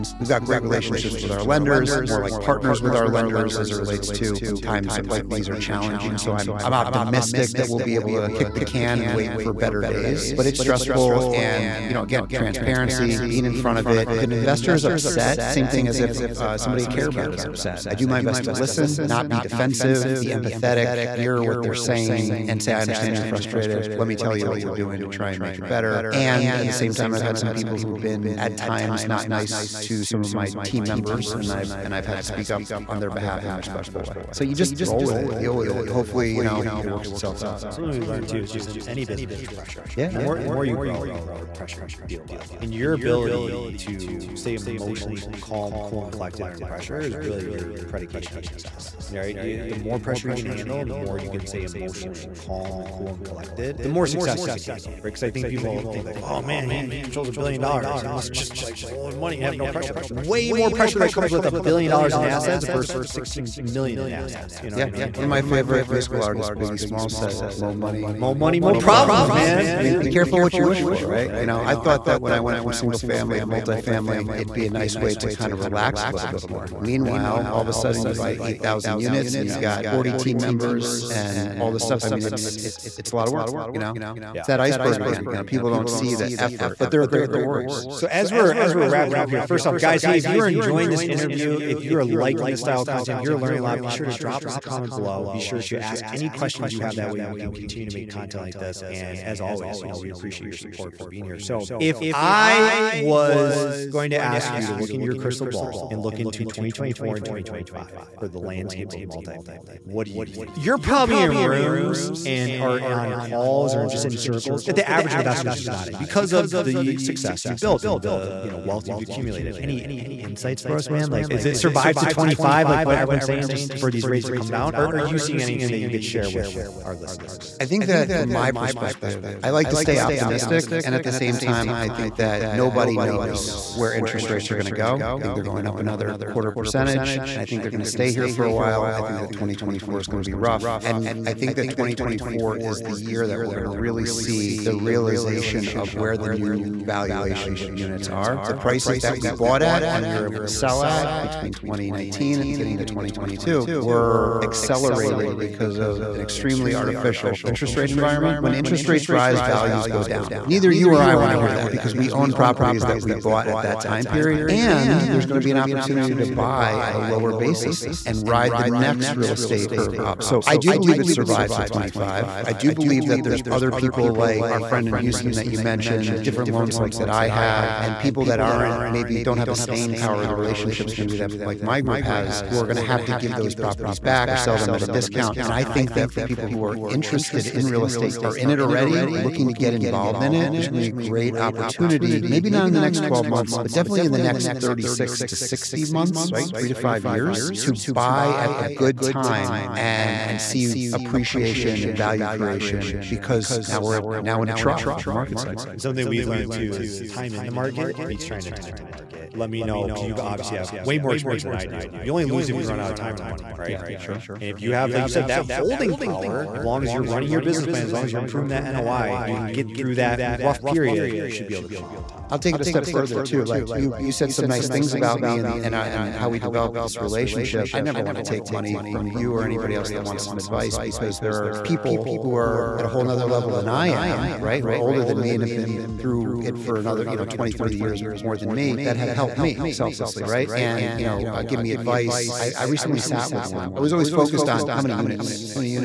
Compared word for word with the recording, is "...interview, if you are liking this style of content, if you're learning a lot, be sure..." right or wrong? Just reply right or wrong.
right.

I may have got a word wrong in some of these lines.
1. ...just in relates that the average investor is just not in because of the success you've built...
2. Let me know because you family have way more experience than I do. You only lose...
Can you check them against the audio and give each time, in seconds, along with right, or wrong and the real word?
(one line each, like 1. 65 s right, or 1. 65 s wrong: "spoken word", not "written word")
1. 113 s wrong: "circles", not "relates"
2. 209 s wrong: "obviously", not "family".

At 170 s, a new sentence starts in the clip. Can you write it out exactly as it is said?
So I do believe it survived till 25.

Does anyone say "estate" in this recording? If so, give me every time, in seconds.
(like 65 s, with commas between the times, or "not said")
169 s, 187 s.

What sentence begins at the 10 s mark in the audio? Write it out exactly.
But it's stressful and, you know, again, transparency, being in front of it.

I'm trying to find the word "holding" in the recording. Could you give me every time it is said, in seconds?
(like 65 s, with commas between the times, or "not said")
215 s.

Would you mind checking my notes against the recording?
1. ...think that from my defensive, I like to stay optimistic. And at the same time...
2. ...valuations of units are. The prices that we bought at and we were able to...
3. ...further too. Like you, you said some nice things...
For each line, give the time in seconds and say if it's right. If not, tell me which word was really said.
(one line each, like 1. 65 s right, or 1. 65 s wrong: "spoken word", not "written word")
1. 127 s wrong: "perspective", not "defensive"
2. 146 s right
3. 222 s right.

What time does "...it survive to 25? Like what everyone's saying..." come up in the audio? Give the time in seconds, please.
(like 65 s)
121 s.